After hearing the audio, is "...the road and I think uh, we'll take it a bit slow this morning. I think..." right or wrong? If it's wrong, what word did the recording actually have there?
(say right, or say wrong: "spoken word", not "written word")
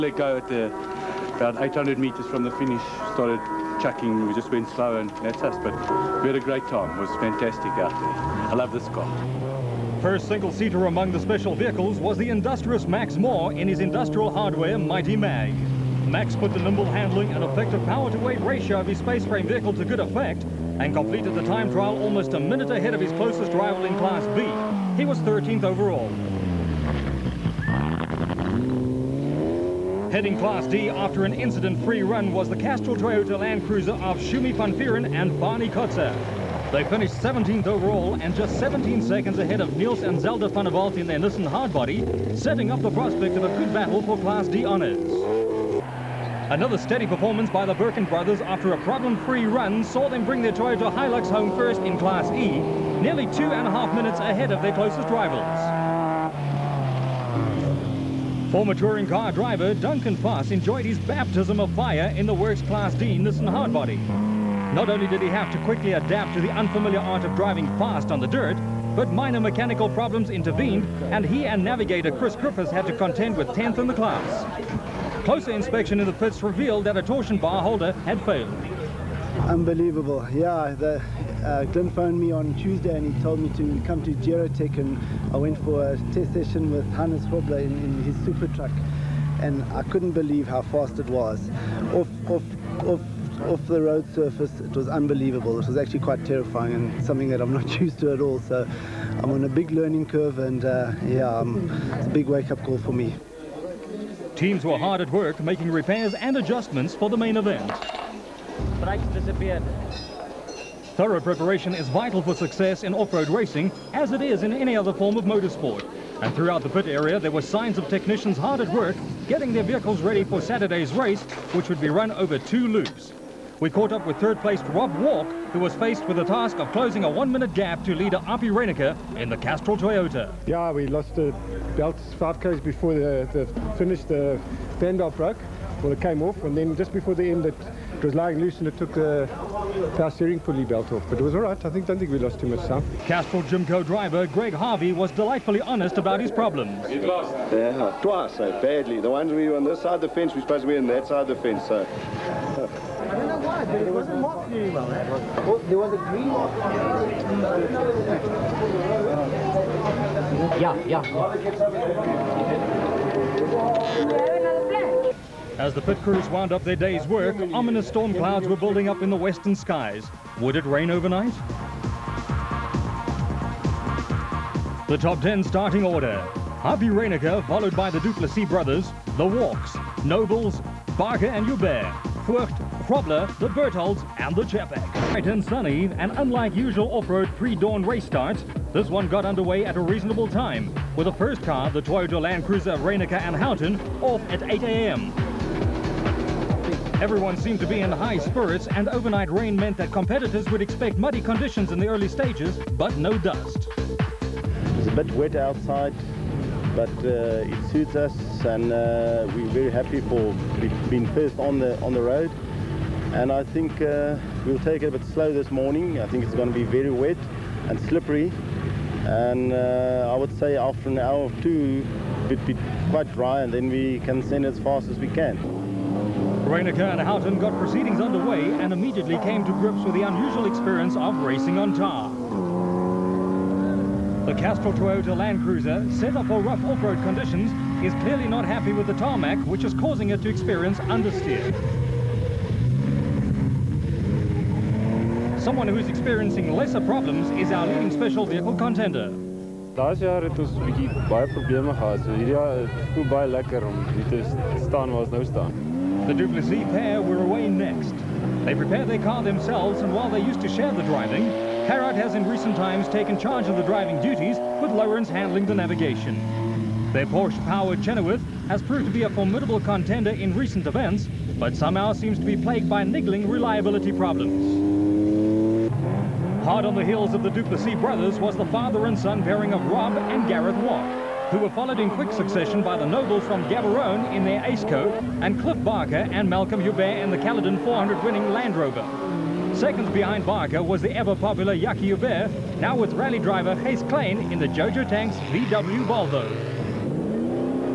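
right.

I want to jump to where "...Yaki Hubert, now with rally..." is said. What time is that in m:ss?
4:51.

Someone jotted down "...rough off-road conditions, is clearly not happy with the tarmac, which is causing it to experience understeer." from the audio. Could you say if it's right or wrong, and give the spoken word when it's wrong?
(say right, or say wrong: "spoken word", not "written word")
right.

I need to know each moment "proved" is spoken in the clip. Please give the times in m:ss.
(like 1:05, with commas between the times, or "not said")
4:28.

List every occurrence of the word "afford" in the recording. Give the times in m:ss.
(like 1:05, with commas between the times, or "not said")
not said.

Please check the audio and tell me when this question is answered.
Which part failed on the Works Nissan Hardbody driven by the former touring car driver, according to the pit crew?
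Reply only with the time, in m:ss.
1:17.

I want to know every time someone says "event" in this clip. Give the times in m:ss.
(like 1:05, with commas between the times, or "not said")
1:47, 4:30.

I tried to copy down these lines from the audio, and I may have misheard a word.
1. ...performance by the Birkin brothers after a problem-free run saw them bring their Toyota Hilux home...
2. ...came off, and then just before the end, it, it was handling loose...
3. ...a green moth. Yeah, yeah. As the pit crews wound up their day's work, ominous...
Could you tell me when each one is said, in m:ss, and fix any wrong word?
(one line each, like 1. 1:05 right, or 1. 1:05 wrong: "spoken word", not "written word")
1. 0:47 right
2. 2:15 wrong: "lying", not "handling"
3. 2:35 right.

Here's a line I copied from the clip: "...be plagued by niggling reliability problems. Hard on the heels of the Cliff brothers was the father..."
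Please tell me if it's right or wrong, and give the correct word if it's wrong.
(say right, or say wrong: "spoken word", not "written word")
wrong: "Duplessis", not "Cliff".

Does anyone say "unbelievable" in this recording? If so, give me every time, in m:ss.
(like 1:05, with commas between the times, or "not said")
1:19, 1:34.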